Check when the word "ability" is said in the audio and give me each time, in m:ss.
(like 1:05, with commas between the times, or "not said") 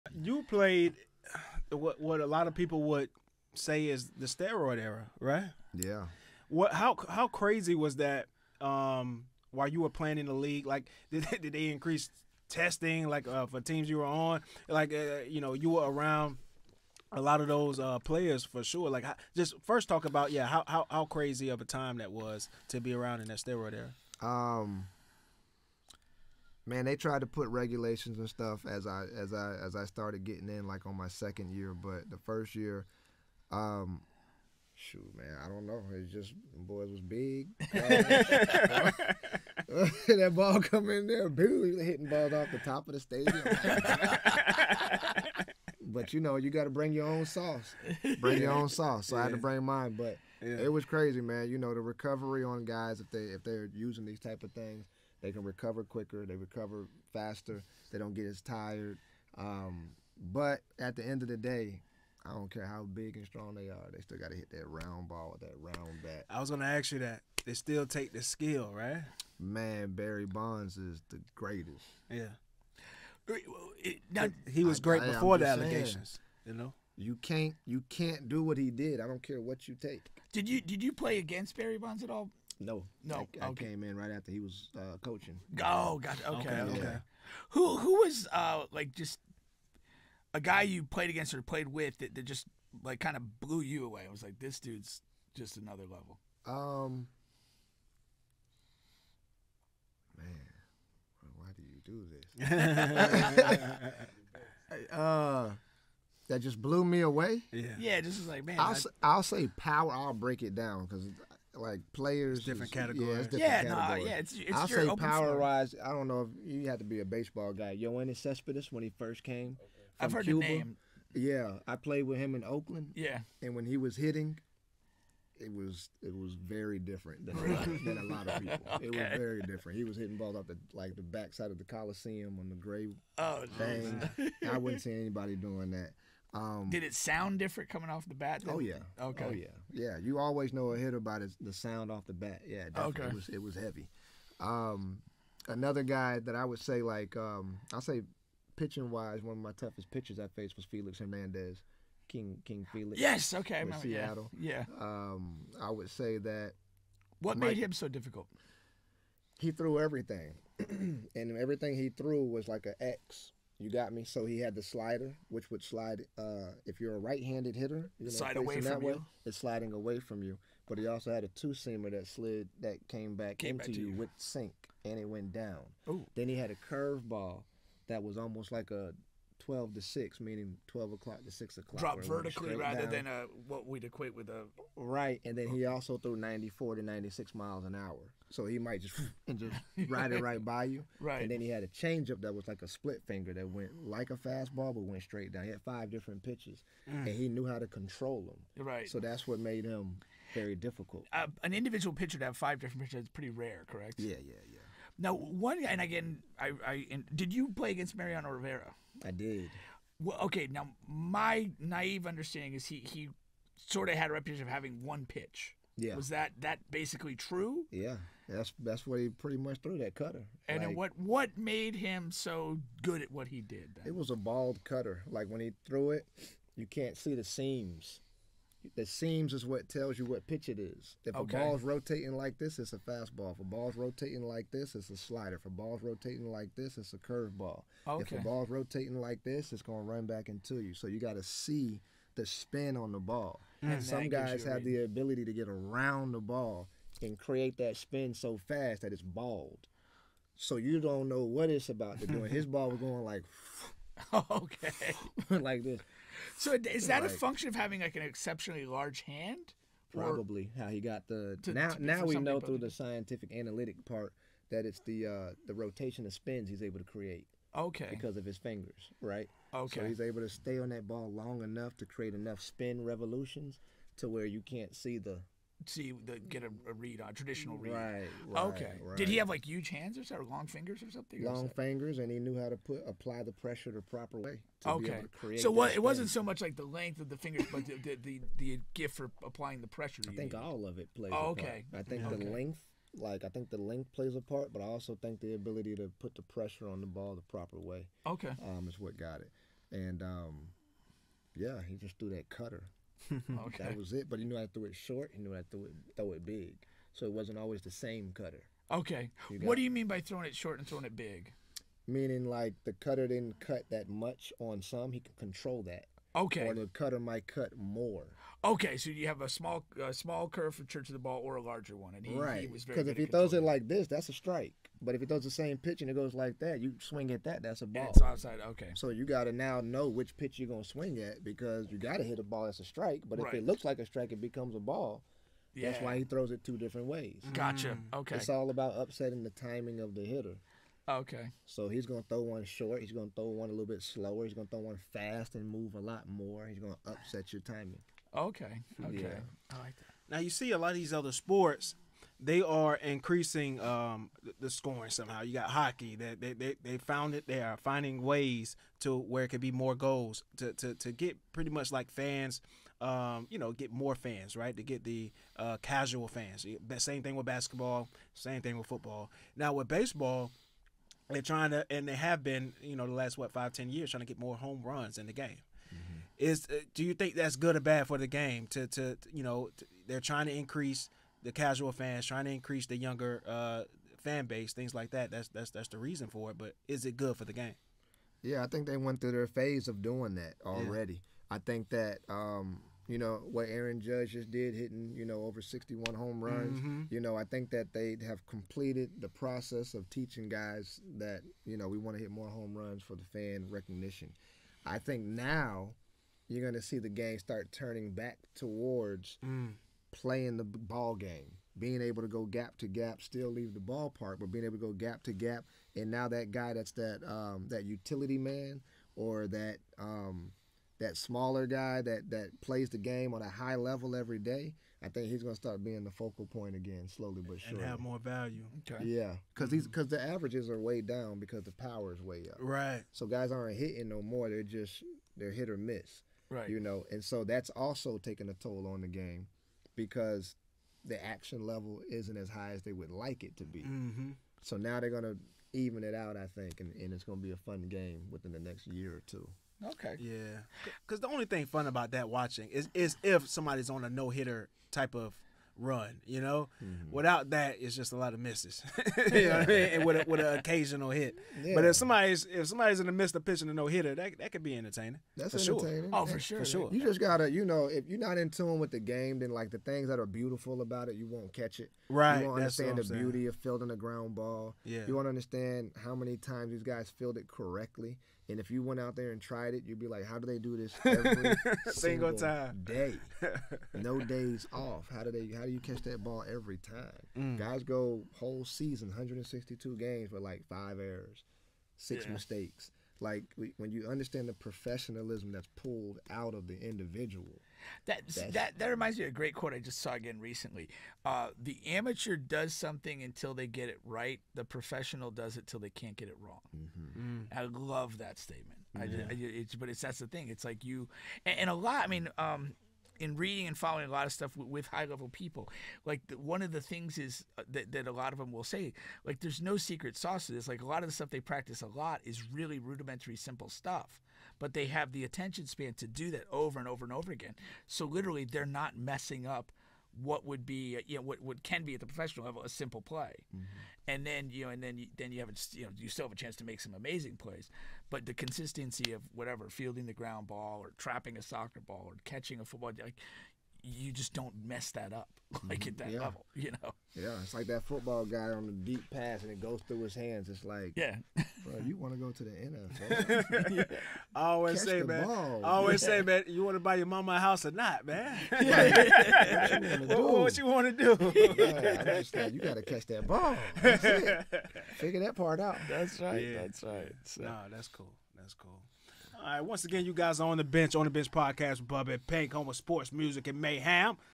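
4:04, 4:55.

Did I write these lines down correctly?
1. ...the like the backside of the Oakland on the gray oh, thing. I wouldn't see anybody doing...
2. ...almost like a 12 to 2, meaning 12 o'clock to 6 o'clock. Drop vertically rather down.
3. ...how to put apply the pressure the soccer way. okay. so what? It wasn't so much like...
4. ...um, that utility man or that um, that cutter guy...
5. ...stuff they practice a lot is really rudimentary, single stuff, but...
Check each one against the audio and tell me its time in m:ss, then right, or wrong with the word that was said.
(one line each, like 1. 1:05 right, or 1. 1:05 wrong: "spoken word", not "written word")
1. 2:10 wrong: "Coliseum", not "Oakland"
2. 2:58 wrong: "6", not "2"
3. 4:42 wrong: "proper", not "soccer"
4. 6:57 wrong: "smaller", not "cutter"
5. 8:40 wrong: "simple", not "single".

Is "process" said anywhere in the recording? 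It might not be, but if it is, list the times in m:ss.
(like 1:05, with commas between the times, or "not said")
6:39.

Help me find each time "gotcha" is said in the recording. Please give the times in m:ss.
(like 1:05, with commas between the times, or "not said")
1:25, 5:37.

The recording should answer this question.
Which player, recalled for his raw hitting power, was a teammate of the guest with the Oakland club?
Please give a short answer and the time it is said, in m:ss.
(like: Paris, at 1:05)
Yoenis Cespedes, at 1:57.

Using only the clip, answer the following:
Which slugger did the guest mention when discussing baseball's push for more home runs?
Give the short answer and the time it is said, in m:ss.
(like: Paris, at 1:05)
Aaron Judge, at 6:33.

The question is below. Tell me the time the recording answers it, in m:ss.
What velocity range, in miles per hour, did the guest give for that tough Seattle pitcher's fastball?
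3:06.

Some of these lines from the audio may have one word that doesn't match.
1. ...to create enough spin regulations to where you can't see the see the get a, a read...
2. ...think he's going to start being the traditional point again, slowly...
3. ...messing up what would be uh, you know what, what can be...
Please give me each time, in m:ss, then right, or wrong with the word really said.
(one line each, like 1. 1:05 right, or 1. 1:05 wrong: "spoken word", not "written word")
1. 4:31 wrong: "revolutions", not "regulations"
2. 7:04 wrong: "focal", not "traditional"
3. 8:48 right.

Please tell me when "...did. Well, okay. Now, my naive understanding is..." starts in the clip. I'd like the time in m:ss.
3:29.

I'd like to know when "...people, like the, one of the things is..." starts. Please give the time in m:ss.
8:35.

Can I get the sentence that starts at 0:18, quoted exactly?
Like just first talk about yeah, how, how how crazy of a time that was to be around in that steroid era.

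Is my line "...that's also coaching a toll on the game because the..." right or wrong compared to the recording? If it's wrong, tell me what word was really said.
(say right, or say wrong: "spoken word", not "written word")
wrong: "taking", not "coaching".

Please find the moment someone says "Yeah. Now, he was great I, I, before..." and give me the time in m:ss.
1:12.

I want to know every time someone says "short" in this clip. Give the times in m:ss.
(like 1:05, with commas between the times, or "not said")
5:04, 5:10, 5:42.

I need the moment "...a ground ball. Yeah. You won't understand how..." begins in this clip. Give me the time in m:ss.
7:53.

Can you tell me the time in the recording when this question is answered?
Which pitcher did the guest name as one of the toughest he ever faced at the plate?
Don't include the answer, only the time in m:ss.
2:30.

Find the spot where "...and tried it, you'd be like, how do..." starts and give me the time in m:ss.
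7:59.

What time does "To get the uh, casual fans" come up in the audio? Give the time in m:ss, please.
6:04.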